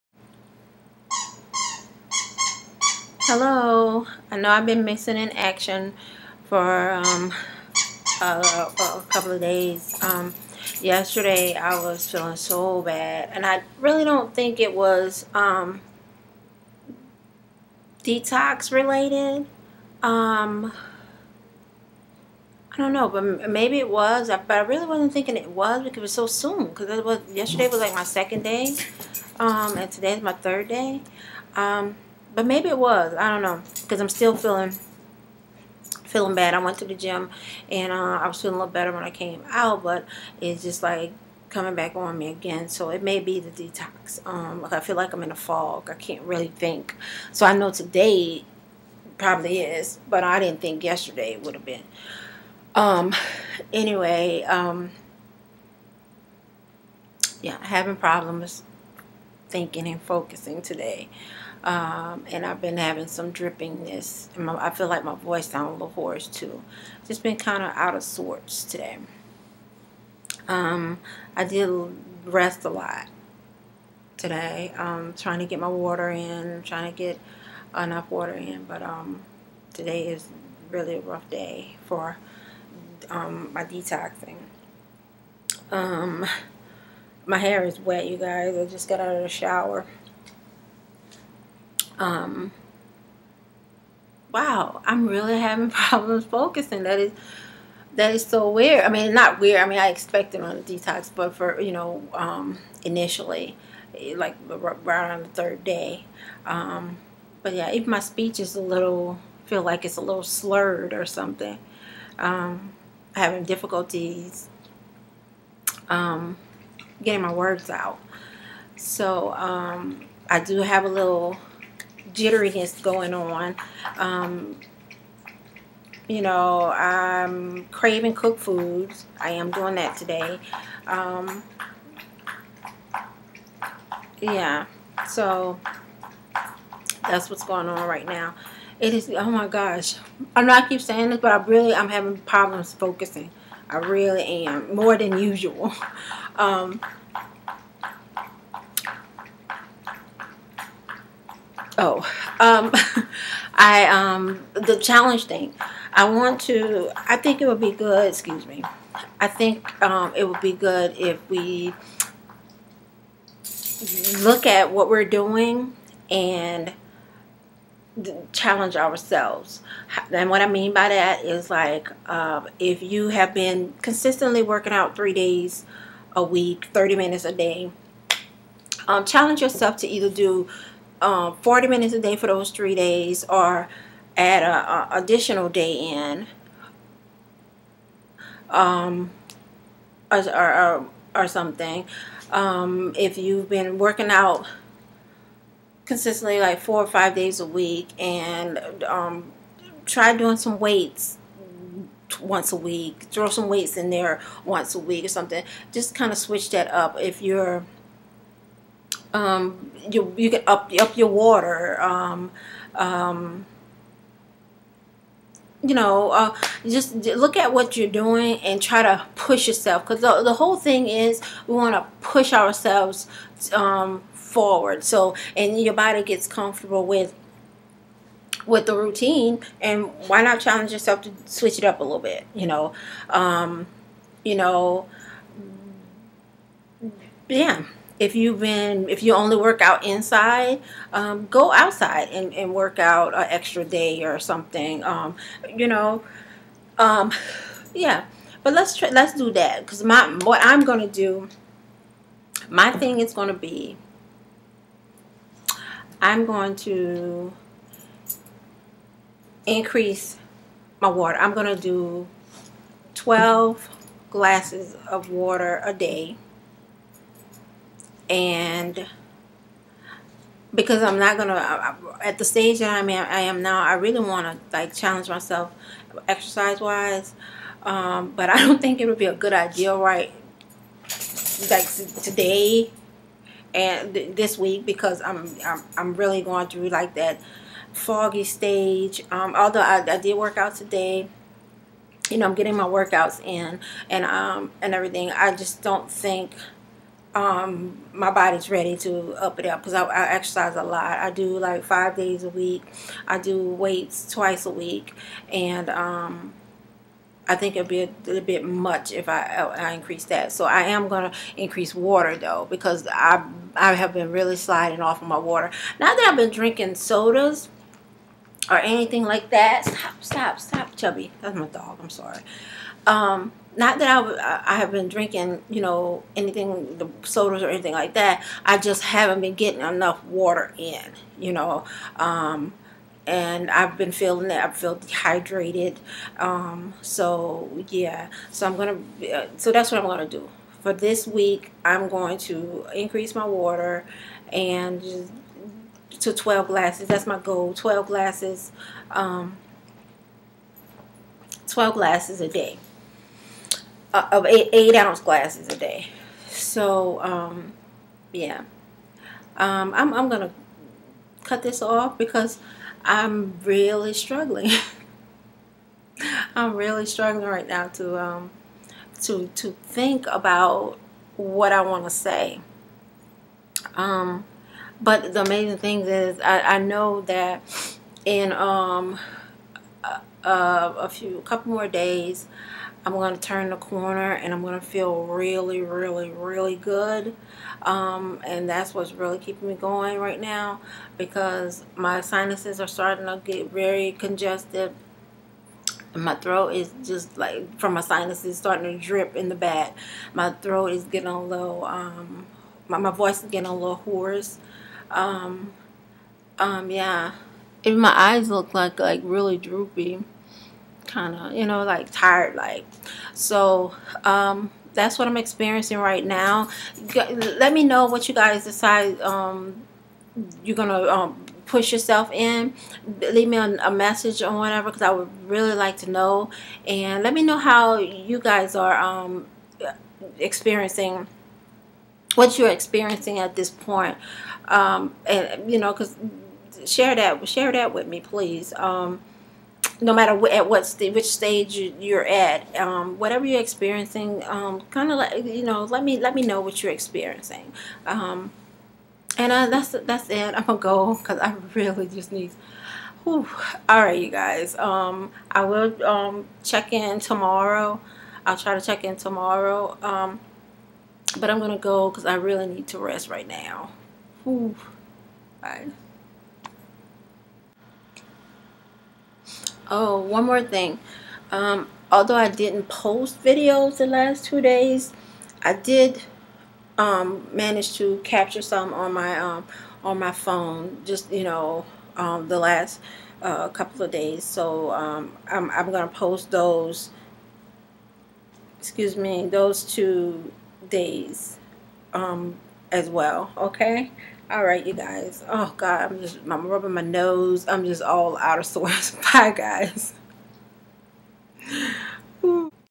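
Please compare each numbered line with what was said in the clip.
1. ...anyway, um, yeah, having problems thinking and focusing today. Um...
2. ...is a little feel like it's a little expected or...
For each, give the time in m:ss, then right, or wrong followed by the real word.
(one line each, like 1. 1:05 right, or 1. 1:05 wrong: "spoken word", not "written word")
1. 0:53 right
2. 1:48 wrong: "slurred", not "expected".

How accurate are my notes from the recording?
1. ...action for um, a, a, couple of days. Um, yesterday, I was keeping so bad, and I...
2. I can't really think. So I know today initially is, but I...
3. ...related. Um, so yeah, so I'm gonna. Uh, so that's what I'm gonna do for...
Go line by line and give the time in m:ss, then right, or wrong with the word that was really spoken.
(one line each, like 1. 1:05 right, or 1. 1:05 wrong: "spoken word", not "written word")
1. 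0:05 wrong: "feeling", not "keeping"
2. 0:45 wrong: "probably", not "initially"
3. 5:34 wrong: "dehydrated", not "related".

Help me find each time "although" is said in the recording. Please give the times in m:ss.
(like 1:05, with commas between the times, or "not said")
4:49, 7:51.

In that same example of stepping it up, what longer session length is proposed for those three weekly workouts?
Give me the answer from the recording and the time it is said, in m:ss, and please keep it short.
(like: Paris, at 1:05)
40 minutes, at 3:01.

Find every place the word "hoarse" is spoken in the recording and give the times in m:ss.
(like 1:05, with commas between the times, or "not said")
1:05, 6:43.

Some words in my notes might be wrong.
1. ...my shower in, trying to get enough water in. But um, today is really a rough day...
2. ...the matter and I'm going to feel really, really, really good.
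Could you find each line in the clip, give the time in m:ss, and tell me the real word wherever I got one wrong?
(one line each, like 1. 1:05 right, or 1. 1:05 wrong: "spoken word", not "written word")
1. 1:15 wrong: "water", not "shower"
2. 6:23 wrong: "corner", not "matter".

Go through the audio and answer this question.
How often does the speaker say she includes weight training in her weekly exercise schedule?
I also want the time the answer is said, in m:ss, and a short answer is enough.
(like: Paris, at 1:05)
Twice a week, at 5:04.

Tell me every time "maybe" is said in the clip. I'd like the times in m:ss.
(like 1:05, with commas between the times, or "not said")
0:23, 0:32.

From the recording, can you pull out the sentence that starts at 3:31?
Um, um, you know, uh, just look at what you're doing and try to push yourself.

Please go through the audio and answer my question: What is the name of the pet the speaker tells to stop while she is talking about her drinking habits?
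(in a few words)
Chubby.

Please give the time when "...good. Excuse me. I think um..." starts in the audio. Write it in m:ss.
2:37.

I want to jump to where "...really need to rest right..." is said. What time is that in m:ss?
7:42.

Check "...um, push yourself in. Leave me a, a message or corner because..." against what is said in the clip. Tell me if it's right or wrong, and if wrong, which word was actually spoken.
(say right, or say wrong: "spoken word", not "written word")
wrong: "whatever", not "corner".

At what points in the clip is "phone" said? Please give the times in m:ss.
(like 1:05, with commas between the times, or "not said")
8:00.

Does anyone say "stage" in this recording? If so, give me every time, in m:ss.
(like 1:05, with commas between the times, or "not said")
4:32, 4:48, 7:21.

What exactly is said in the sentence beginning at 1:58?
So um, I do have a little jitteriness going on.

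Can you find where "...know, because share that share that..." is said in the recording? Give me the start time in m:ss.
7:15.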